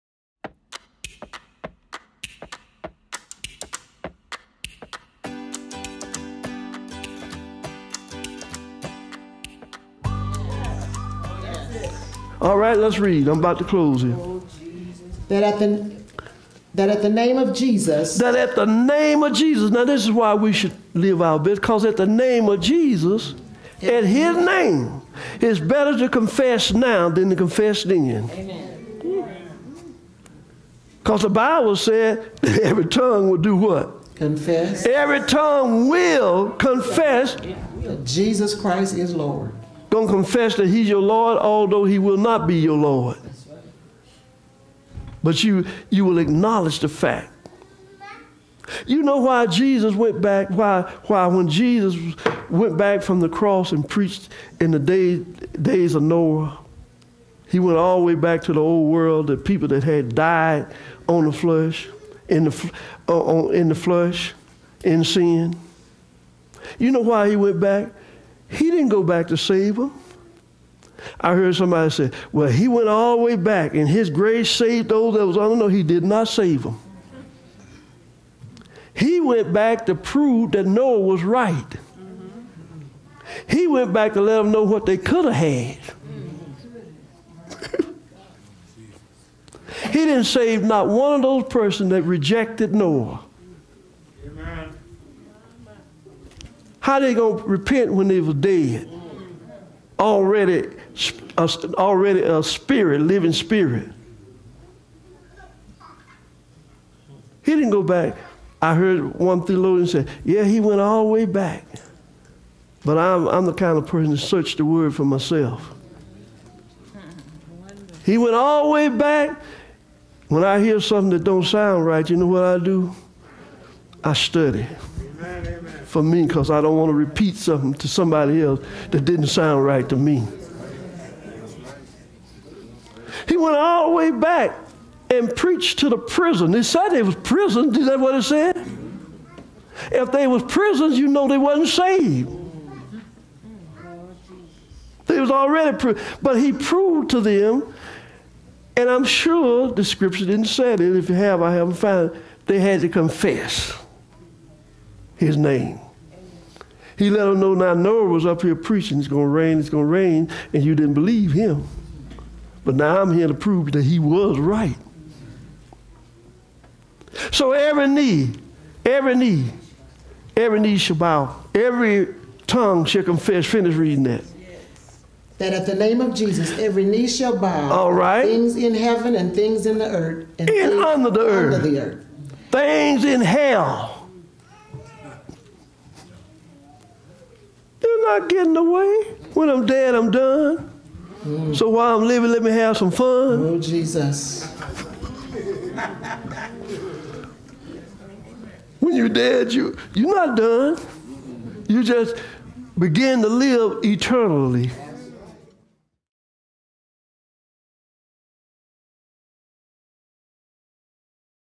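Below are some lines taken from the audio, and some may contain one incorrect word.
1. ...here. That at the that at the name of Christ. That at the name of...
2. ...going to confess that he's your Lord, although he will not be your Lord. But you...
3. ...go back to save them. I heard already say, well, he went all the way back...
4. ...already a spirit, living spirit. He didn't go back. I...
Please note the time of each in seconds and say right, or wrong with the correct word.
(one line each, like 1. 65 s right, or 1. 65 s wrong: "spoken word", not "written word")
1. 14 s wrong: "Jesus", not "Christ"
2. 39 s right
3. 68 s wrong: "somebody", not "already"
4. 101 s right.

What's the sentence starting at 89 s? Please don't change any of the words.
he didn't save not one of those persons that rejected Noah.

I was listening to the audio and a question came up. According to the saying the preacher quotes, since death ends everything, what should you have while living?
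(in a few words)
some fun.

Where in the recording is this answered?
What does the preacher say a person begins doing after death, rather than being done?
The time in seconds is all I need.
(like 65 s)
202 s.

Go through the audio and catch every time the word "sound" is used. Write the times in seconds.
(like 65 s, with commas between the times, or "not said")
121 s, 129 s.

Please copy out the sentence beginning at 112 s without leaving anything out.
But I'm, I'm the kind of person to search the word for myself.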